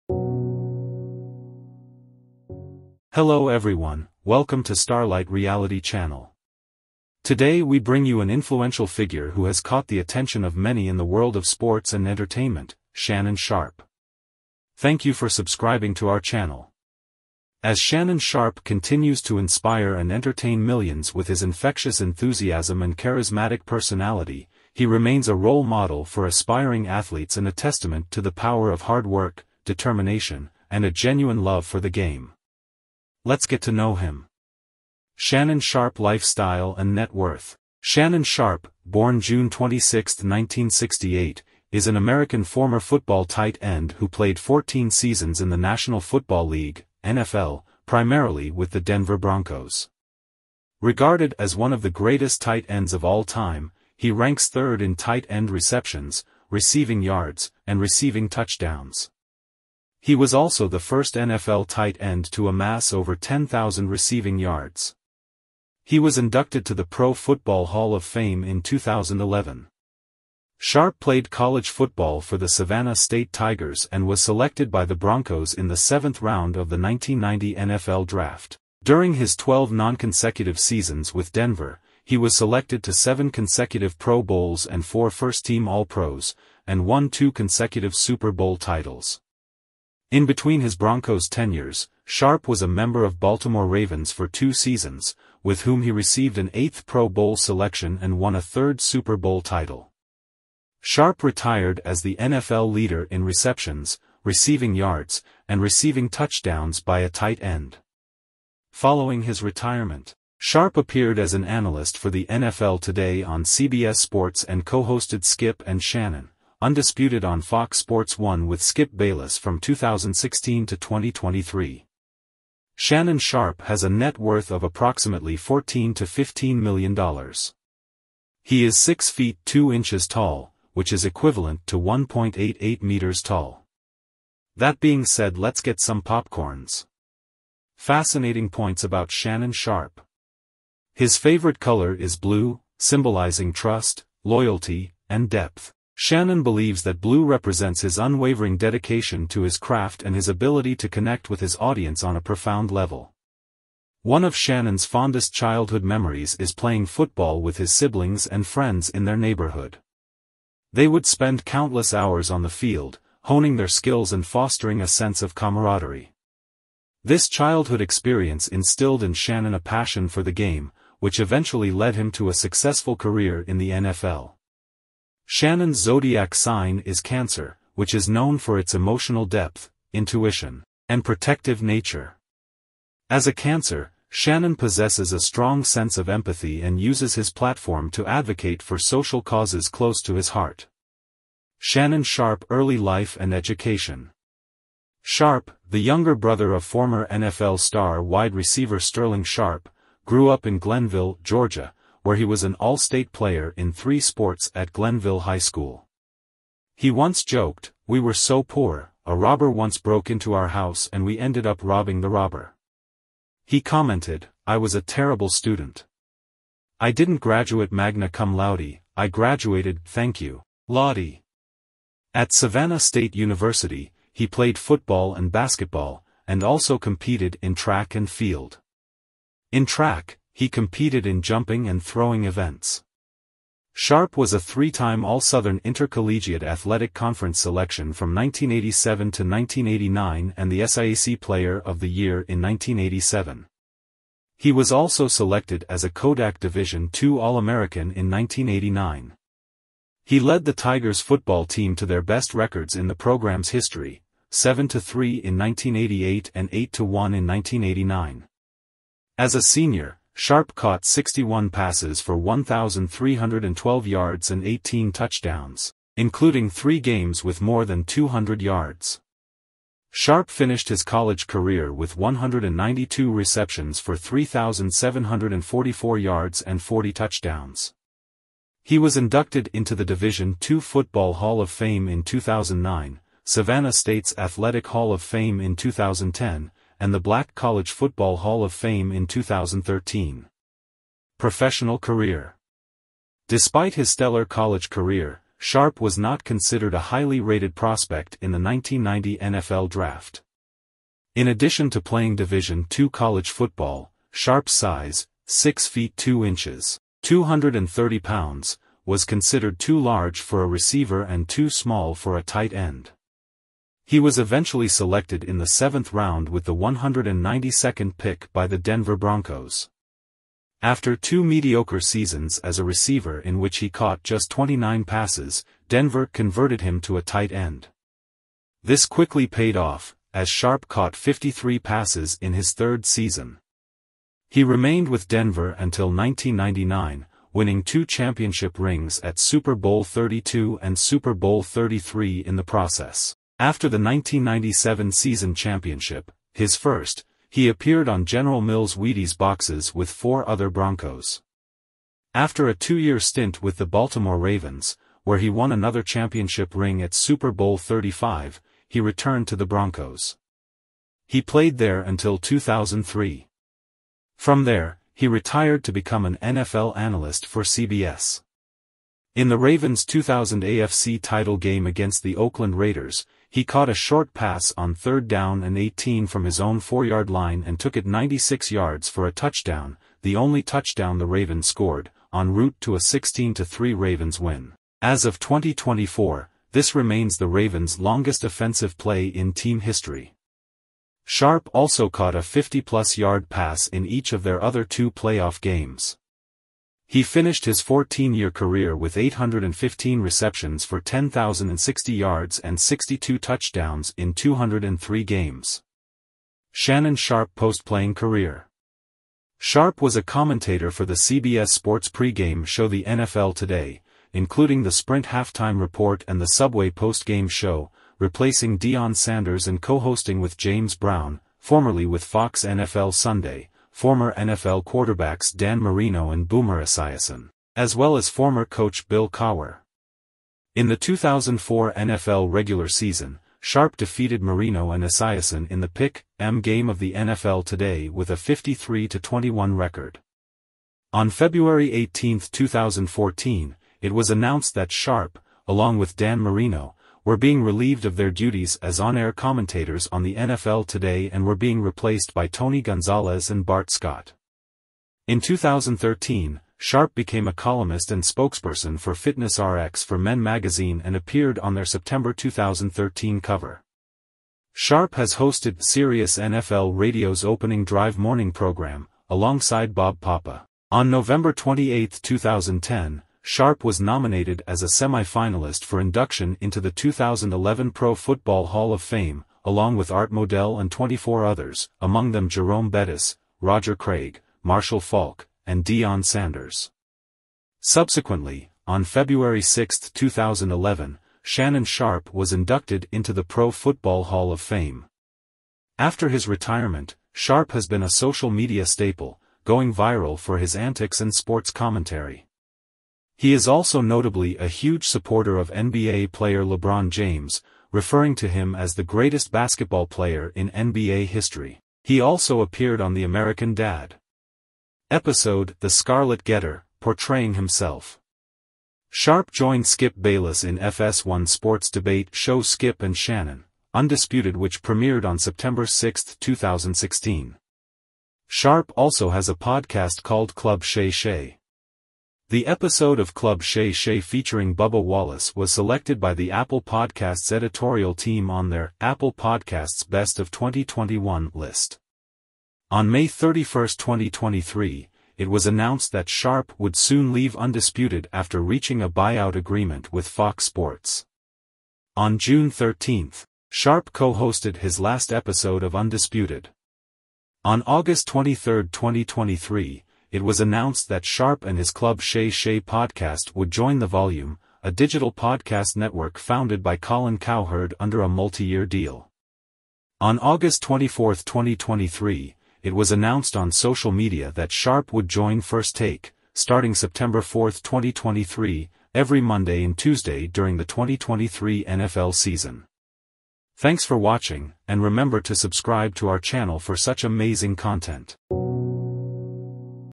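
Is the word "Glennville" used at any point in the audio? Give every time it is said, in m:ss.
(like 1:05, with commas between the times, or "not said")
3:20, 3:24.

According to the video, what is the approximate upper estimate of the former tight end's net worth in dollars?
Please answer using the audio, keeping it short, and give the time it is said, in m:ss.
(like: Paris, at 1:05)
15 million, at 2:06.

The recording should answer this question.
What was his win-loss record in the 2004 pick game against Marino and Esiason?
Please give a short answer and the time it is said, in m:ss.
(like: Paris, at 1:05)
53-21, at 7:18.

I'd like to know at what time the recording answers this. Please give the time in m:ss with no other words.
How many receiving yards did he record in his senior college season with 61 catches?
4:22.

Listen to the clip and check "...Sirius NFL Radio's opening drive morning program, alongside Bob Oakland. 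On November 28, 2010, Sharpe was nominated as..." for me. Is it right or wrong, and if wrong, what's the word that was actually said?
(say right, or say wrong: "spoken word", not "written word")
wrong: "Papa", not "Oakland".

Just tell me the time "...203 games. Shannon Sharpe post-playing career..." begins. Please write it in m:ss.
6:44.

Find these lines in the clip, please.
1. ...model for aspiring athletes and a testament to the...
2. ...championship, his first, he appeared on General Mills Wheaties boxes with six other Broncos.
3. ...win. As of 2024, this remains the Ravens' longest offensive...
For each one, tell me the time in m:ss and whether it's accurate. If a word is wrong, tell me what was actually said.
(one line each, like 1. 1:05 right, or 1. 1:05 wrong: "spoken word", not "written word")
1. 0:25 right
2. 5:45 wrong: "four", not "six"
3. 6:24 right.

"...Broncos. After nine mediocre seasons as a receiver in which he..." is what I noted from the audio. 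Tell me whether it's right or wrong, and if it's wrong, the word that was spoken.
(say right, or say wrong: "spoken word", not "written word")
wrong: "two", not "nine".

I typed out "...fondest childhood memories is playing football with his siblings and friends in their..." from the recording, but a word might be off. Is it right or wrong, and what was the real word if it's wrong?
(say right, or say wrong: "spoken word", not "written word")
right.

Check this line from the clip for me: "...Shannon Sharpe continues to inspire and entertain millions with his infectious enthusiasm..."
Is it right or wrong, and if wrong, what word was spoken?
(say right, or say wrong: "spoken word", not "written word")
right.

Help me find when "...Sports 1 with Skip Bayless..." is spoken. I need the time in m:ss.
1:57.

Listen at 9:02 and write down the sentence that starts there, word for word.
On May 31, 2023, it was announced that Sharpe would soon leave Undisputed after reaching a buyout agreement with Fox Sports.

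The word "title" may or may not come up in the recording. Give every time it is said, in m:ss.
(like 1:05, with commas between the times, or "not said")
1:28, 1:39, 6:11.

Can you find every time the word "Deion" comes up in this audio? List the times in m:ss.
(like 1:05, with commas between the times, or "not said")
6:58, 8:05.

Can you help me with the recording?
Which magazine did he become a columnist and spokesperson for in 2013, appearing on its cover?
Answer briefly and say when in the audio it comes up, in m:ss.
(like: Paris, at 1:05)
Fitness RX for Men, at 7:38.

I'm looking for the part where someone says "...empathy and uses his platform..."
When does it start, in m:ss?
3:06.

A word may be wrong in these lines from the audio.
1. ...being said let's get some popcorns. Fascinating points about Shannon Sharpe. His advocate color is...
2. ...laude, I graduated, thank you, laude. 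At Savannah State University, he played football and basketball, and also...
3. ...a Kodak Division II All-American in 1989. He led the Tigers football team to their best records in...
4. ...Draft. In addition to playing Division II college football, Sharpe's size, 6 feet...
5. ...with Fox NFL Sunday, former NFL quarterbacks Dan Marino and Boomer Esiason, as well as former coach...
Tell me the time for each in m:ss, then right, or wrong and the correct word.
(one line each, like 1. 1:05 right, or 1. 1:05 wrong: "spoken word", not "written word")
1. 2:14 wrong: "favorite", not "advocate"
2. 3:38 right
3. 4:05 right
4. 4:59 right
5. 7:01 right.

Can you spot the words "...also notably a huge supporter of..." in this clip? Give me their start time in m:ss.
8:23.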